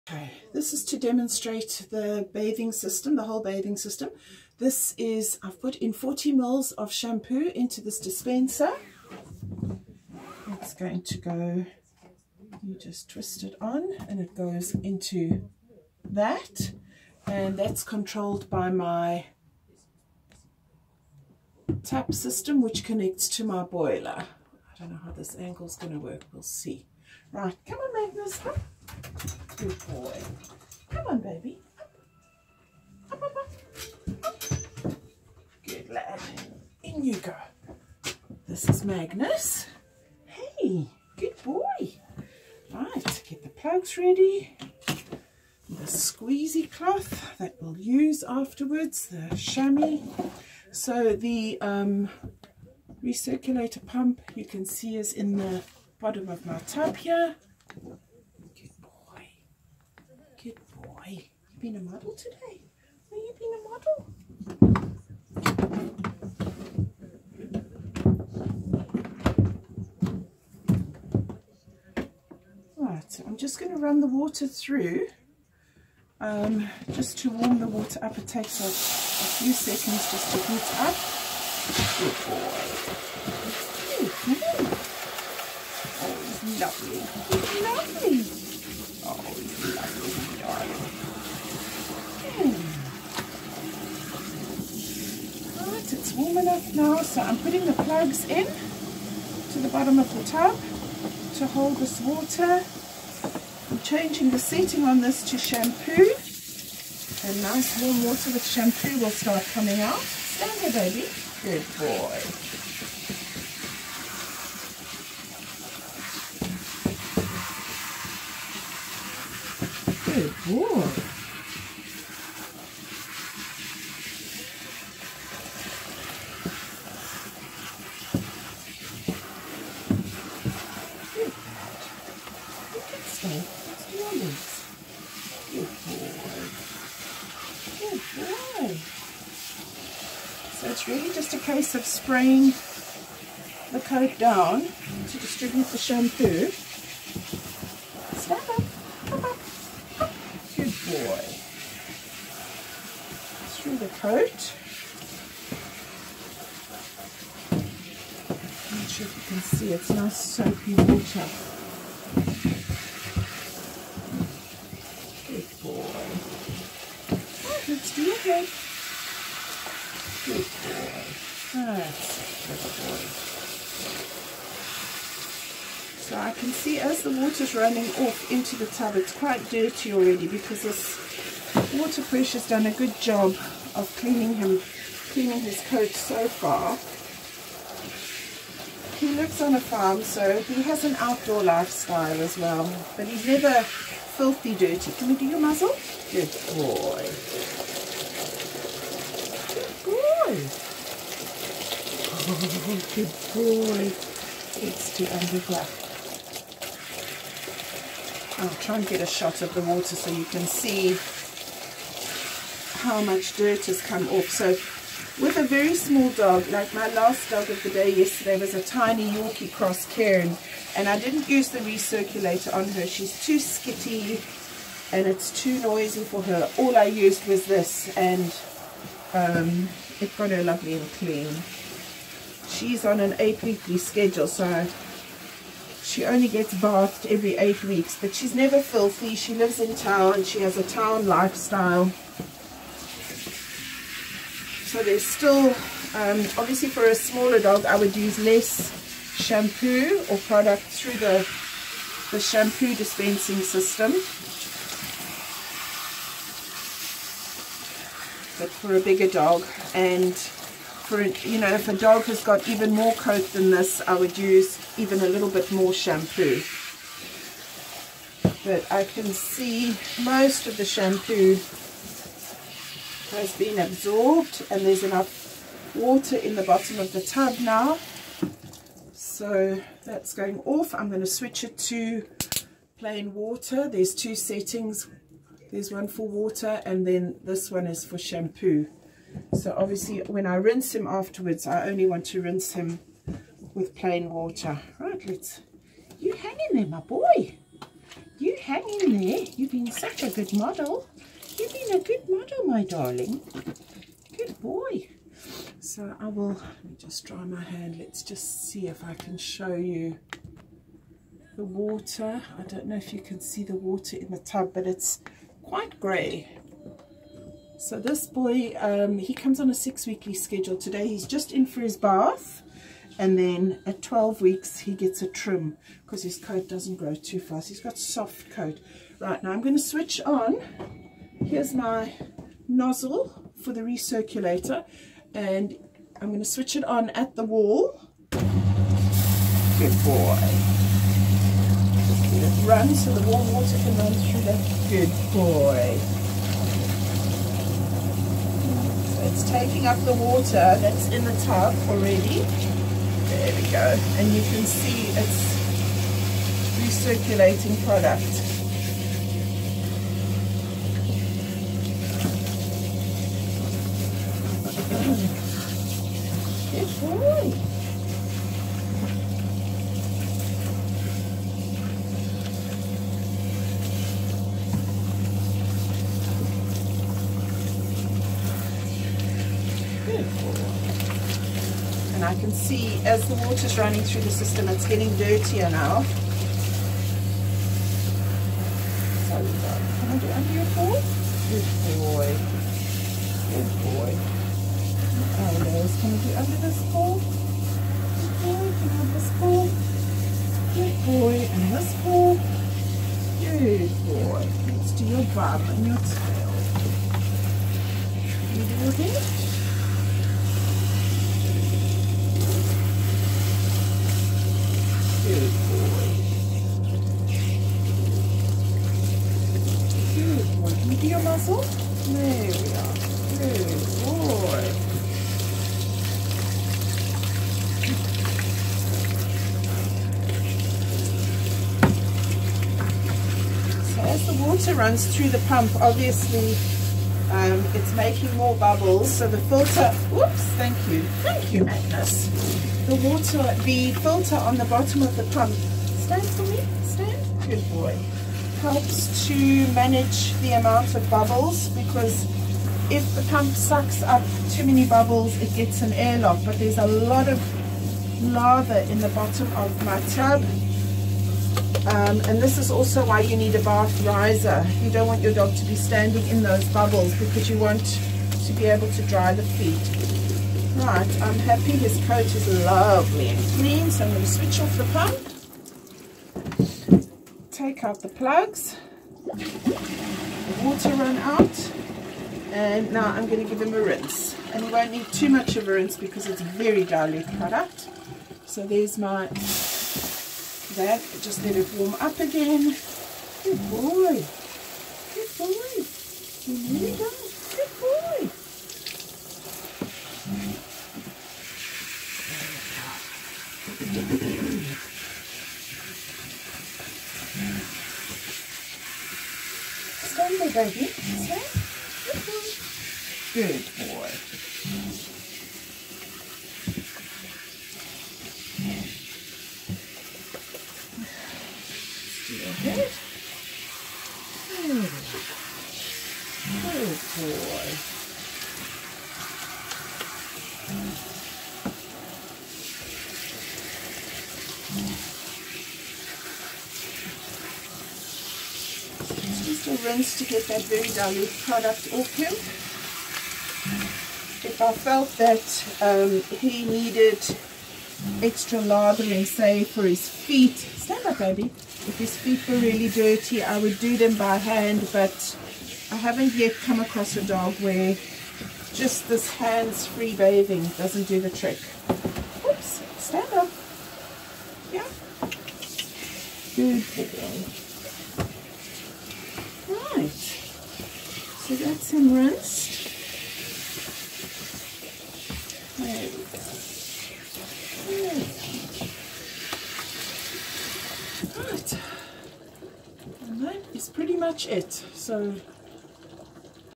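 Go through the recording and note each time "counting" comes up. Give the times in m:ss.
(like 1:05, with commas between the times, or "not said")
not said.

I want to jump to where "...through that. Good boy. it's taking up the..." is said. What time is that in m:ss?
5:43.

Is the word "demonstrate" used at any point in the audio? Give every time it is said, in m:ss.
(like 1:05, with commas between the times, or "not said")
0:00.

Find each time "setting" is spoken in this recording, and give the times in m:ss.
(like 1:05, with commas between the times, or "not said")
1:44, 4:44.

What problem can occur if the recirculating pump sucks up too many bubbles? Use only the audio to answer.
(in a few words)
an airlock.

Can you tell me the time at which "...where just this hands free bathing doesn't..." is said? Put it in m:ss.
9:17.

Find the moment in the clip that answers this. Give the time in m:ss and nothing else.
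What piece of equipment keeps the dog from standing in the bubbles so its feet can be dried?
7:43.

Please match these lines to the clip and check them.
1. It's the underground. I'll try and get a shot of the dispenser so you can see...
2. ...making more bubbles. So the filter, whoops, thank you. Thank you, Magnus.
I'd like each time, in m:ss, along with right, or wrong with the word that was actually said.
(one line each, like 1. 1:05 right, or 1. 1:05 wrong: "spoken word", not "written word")
1. 3:24 wrong: "water", not "dispenser"
2. 7:17 right.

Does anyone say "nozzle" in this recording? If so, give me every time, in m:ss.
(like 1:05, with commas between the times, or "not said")
5:32.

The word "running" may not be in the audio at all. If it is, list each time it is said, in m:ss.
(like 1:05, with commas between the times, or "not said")
2:57, 6:23.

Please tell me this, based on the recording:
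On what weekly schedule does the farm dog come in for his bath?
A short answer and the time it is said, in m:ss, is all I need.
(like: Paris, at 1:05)
6 weeks, at 5:19.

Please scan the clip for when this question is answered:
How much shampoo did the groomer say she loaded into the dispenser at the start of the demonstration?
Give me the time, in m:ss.
0:05.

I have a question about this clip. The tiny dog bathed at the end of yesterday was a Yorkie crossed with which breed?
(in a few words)
Cairn.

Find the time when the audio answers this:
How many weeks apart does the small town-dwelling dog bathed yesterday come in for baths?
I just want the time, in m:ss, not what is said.
3:53.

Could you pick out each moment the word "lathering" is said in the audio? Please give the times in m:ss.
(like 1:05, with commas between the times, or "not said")
9:08.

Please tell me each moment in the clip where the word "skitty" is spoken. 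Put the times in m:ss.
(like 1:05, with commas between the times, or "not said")
3:43.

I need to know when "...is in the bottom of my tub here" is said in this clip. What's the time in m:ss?
0:54.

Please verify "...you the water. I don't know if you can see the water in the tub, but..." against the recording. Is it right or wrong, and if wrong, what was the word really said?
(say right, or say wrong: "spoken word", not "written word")
right.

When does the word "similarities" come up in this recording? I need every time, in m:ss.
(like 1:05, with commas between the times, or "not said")
not said.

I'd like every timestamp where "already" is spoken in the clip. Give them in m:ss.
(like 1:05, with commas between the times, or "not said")
2:59, 5:51.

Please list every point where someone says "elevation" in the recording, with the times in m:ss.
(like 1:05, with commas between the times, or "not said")
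not said.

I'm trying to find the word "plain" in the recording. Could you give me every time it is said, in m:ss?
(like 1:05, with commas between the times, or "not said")
4:42, 4:53.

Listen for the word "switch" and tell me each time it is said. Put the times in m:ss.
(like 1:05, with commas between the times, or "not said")
4:41, 5:29, 5:36, 7:54.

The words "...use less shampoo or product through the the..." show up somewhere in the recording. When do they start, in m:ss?
4:07.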